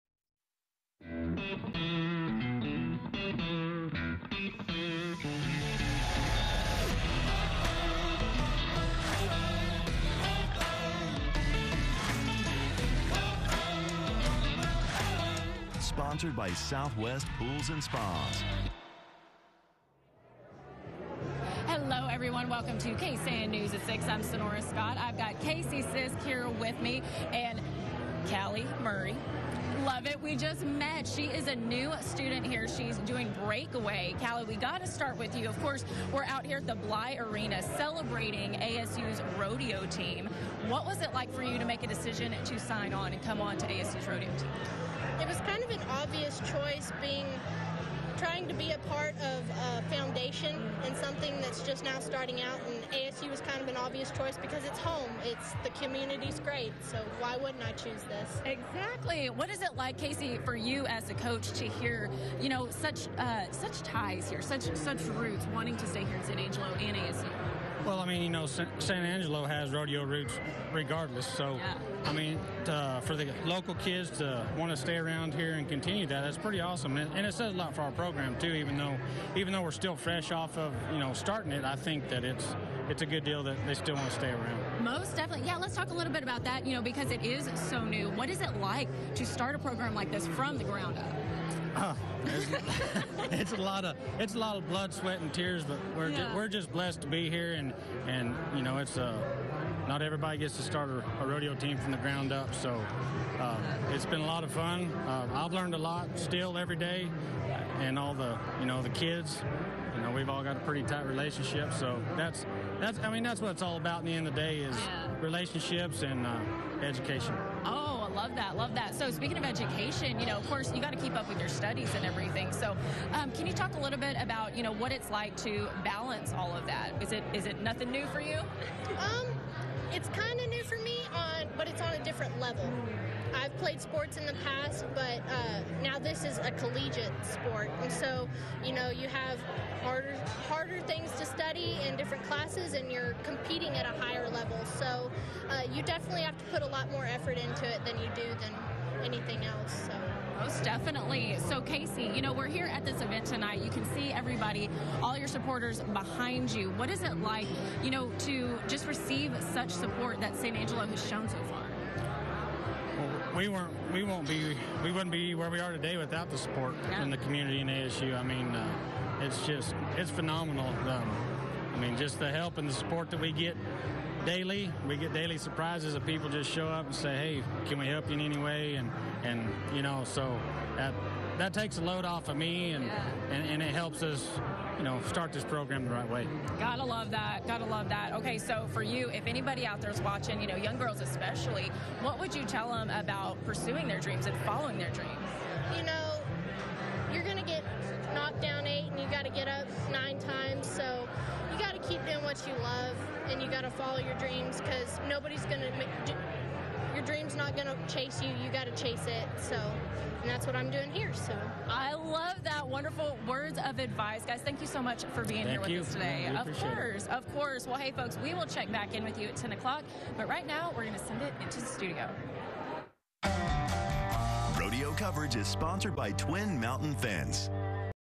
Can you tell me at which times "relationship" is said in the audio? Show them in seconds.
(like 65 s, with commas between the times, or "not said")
111 s, 115 s.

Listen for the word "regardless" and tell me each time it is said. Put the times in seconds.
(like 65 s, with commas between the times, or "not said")
70 s.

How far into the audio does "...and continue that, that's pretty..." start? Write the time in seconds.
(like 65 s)
75 s.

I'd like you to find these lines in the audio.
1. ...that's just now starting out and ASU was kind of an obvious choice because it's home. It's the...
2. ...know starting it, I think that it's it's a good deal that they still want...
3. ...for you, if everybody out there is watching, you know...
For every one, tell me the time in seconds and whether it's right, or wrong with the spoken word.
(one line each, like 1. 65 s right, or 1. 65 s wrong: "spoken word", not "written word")
1. 51 s right
2. 80 s right
3. 188 s wrong: "anybody", not "everybody".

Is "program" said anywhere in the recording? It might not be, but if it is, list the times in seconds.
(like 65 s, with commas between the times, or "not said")
77 s, 89 s, 185 s.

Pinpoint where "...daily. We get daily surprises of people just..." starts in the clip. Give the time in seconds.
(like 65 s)
174 s.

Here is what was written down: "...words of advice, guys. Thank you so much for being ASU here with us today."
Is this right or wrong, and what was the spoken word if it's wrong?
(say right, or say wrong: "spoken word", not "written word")
wrong: "Thank", not "ASU".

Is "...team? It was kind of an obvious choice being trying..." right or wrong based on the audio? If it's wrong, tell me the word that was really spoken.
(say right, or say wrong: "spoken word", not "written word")
right.